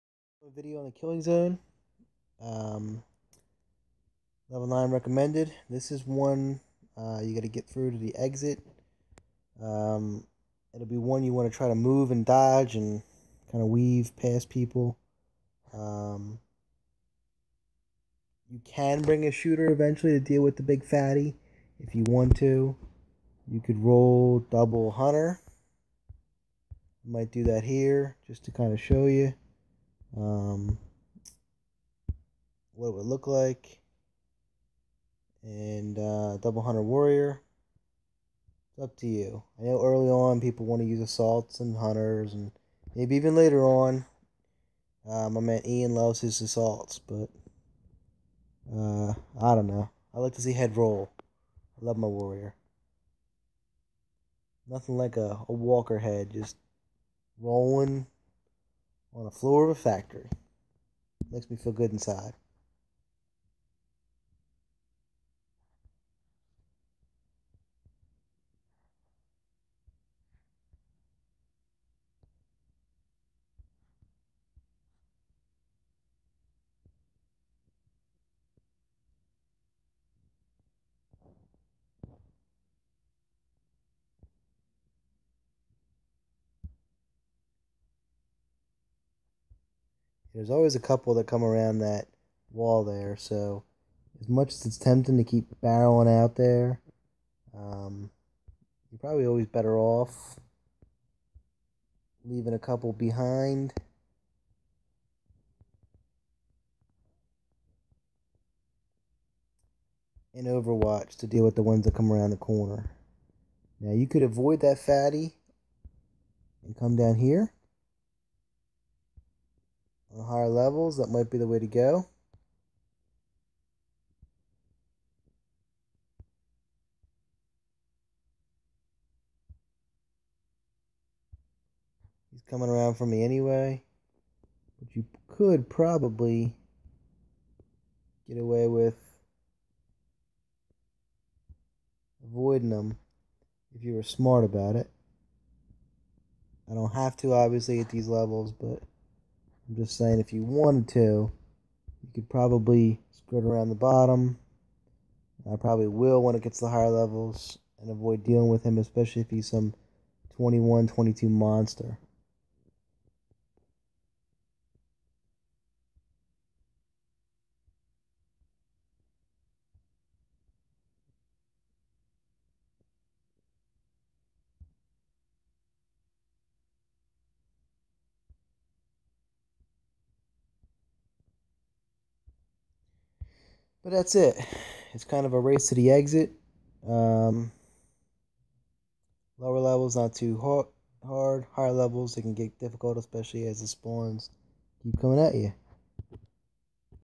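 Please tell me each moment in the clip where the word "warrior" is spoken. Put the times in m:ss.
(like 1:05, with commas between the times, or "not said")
0:36, 0:52.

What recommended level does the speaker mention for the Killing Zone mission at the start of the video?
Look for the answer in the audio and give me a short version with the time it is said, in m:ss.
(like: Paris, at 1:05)
9, at 0:04.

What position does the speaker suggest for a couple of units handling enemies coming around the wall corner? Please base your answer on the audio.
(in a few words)
Overwatch.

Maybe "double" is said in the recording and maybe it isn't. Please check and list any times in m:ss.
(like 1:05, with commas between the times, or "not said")
0:24, 0:36.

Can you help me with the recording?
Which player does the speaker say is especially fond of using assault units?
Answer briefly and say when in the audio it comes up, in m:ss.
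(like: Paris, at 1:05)
Ian, at 0:45.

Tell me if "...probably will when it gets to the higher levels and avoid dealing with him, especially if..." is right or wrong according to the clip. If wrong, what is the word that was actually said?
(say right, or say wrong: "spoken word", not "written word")
right.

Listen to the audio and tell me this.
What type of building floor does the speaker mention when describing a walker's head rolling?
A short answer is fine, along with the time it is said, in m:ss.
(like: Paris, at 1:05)
factory, at 0:59.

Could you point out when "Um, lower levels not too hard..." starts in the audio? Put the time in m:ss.
3:06.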